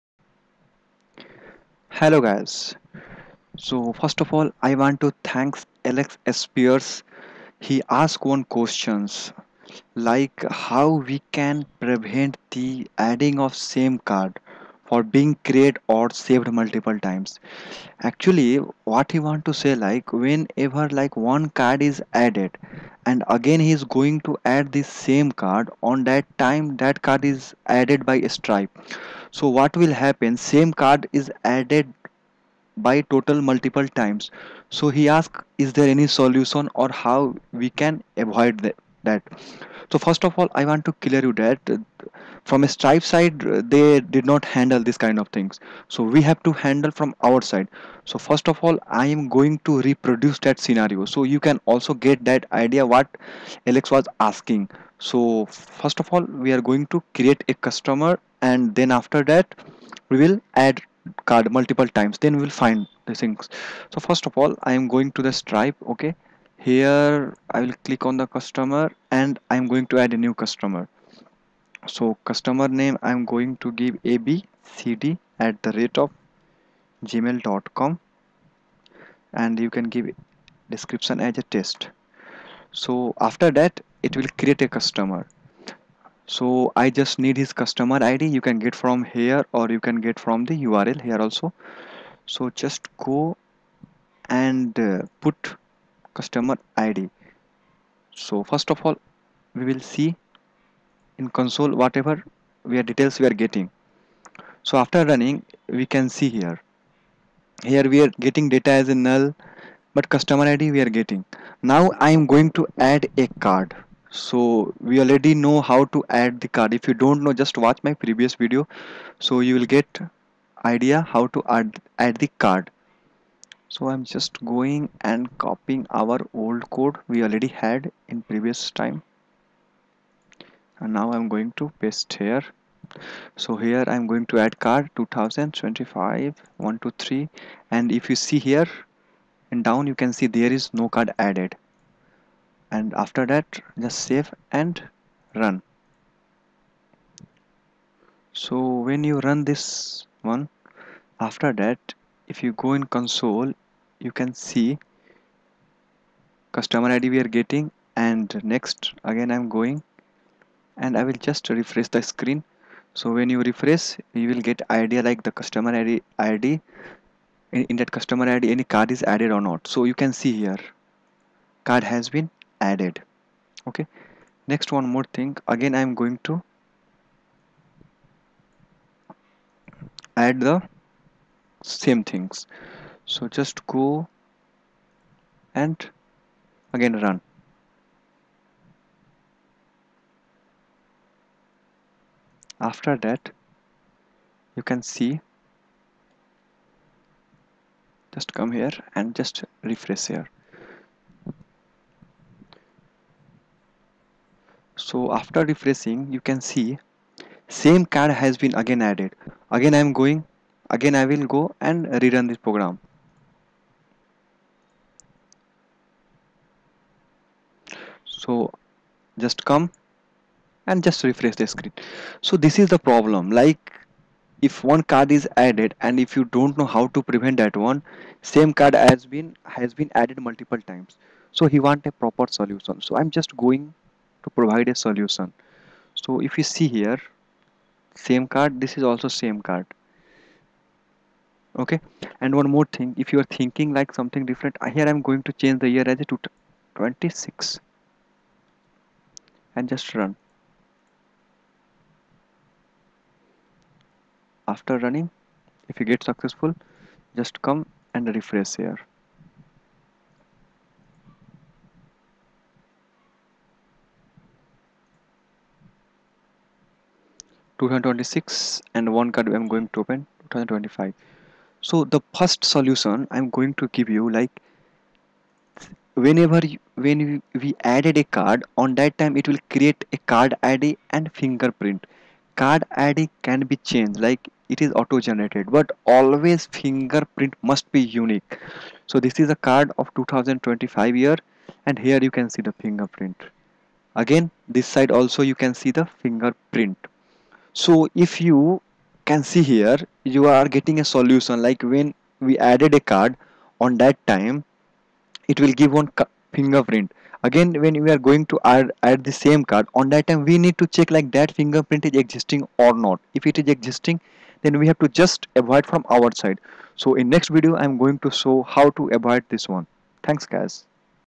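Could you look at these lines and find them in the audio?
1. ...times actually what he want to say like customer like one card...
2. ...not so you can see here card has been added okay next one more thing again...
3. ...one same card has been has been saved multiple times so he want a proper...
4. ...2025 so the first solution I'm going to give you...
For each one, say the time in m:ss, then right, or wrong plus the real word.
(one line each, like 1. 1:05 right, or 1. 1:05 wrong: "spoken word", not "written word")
1. 0:17 wrong: "whenever", not "customer"
2. 2:49 right
3. 3:47 wrong: "added", not "saved"
4. 4:30 right.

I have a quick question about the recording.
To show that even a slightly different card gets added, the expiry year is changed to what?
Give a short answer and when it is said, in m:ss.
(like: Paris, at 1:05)
2026, at 4:06.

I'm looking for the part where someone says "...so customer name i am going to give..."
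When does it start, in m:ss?
1:11.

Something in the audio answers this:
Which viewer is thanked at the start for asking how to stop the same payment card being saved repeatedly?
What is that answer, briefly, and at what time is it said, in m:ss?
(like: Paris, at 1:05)
Alex Spears, at 0:05.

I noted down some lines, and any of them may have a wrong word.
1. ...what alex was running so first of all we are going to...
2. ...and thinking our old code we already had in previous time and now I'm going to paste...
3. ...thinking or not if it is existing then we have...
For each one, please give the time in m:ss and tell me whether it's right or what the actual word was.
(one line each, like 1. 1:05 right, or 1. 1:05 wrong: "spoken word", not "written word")
1. 0:52 wrong: "asking", not "running"
2. 2:04 wrong: "copying", not "thinking"
3. 5:11 wrong: "existing", not "thinking".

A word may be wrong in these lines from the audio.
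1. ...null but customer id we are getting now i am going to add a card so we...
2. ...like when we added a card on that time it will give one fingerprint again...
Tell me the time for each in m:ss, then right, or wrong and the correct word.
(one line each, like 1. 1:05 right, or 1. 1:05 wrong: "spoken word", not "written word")
1. 1:48 right
2. 5:01 right.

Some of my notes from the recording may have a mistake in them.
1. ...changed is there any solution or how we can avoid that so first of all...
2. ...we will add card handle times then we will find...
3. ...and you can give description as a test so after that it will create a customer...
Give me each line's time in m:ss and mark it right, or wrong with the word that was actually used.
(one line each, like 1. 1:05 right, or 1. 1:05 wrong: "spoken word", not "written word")
1. 0:35 wrong: "asked", not "changed"
2. 1:00 wrong: "multiple", not "handle"
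3. 1:19 right.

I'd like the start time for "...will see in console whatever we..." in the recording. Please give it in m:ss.
1:39.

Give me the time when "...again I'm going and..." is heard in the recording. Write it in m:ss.
2:39.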